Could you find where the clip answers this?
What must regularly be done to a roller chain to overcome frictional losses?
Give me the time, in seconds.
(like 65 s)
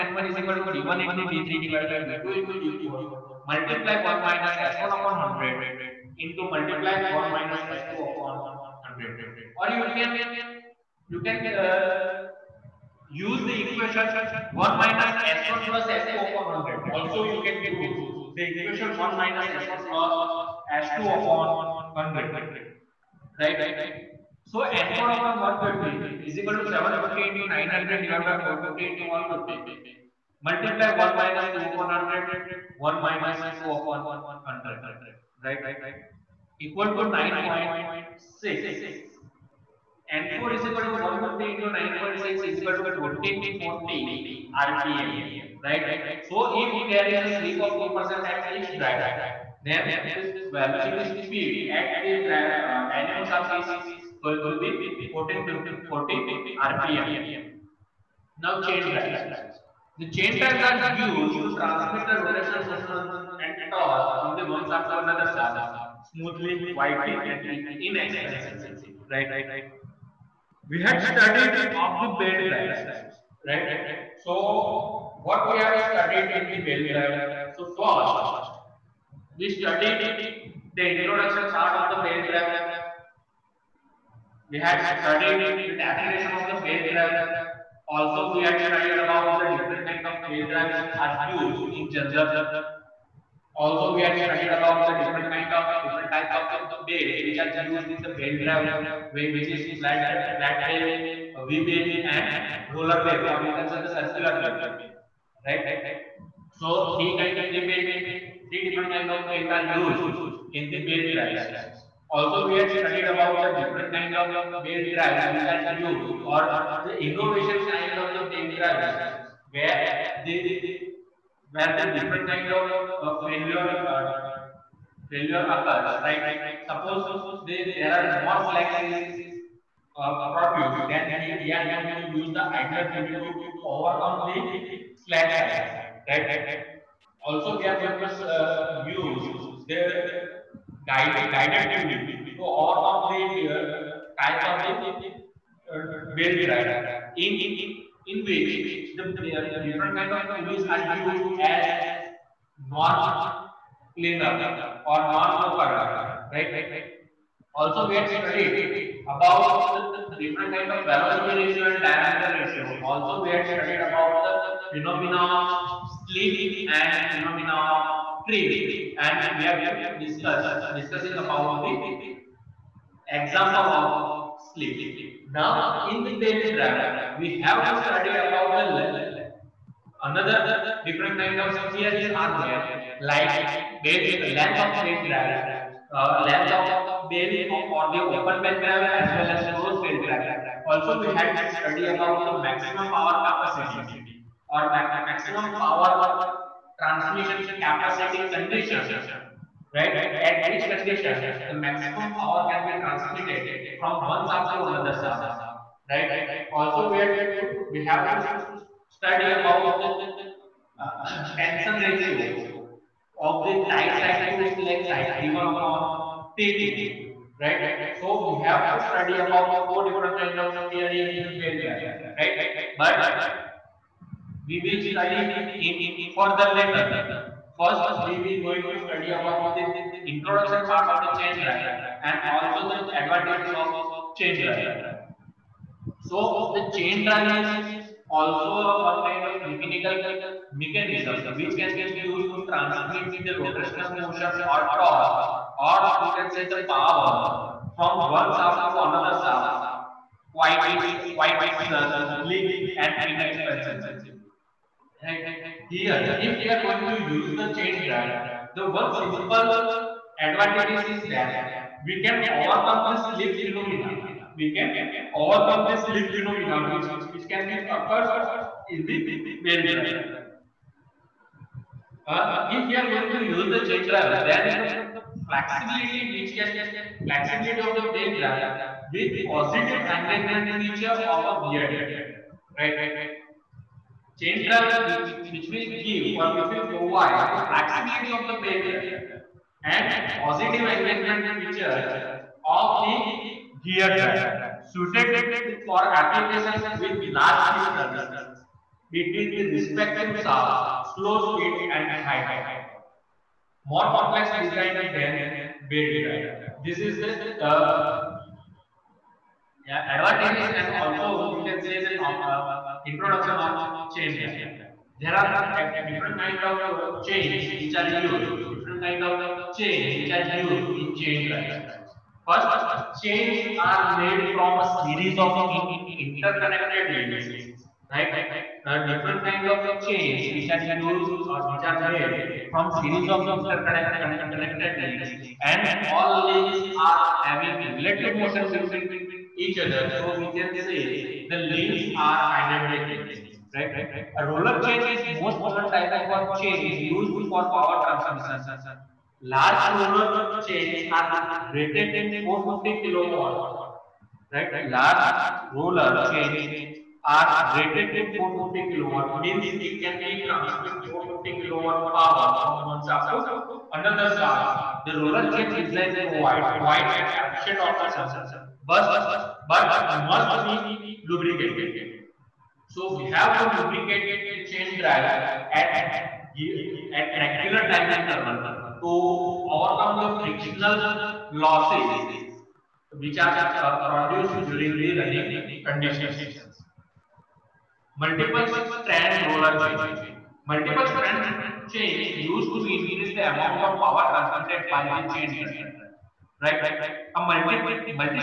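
373 s.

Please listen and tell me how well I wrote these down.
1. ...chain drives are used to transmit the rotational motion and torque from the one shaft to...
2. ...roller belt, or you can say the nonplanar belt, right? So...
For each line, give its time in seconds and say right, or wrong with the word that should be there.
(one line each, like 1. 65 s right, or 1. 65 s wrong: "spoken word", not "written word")
1. 60 s right
2. 102 s wrong: "circular", not "nonplanar".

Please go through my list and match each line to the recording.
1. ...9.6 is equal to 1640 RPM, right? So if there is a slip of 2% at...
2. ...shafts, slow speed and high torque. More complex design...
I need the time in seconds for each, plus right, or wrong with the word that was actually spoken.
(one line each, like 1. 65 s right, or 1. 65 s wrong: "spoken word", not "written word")
1. 41 s wrong: "1440", not "1640"
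2. 300 s right.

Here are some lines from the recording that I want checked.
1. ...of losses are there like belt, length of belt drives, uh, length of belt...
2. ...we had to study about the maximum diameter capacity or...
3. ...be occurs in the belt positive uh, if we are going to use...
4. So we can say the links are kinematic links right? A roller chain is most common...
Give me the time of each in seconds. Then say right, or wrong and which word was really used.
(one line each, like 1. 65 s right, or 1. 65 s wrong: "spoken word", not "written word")
1. 181 s wrong: "theories", not "losses"
2. 190 s wrong: "power", not "diameter"
3. 267 s wrong: "drive", not "positive"
4. 339 s right.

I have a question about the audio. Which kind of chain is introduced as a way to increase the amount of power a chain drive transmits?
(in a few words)
multiple strand roller chain.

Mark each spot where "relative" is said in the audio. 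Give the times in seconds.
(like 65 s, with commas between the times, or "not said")
337 s.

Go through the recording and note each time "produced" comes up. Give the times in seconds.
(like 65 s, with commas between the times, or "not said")
130 s, 383 s.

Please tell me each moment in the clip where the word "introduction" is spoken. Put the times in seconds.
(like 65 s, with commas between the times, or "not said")
80 s, 230 s, 312 s.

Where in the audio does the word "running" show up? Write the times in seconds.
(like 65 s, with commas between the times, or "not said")
384 s.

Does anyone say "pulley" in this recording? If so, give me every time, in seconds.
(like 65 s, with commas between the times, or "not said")
132 s, 141 s, 150 s.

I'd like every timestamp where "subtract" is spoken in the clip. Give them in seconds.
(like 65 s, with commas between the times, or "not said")
not said.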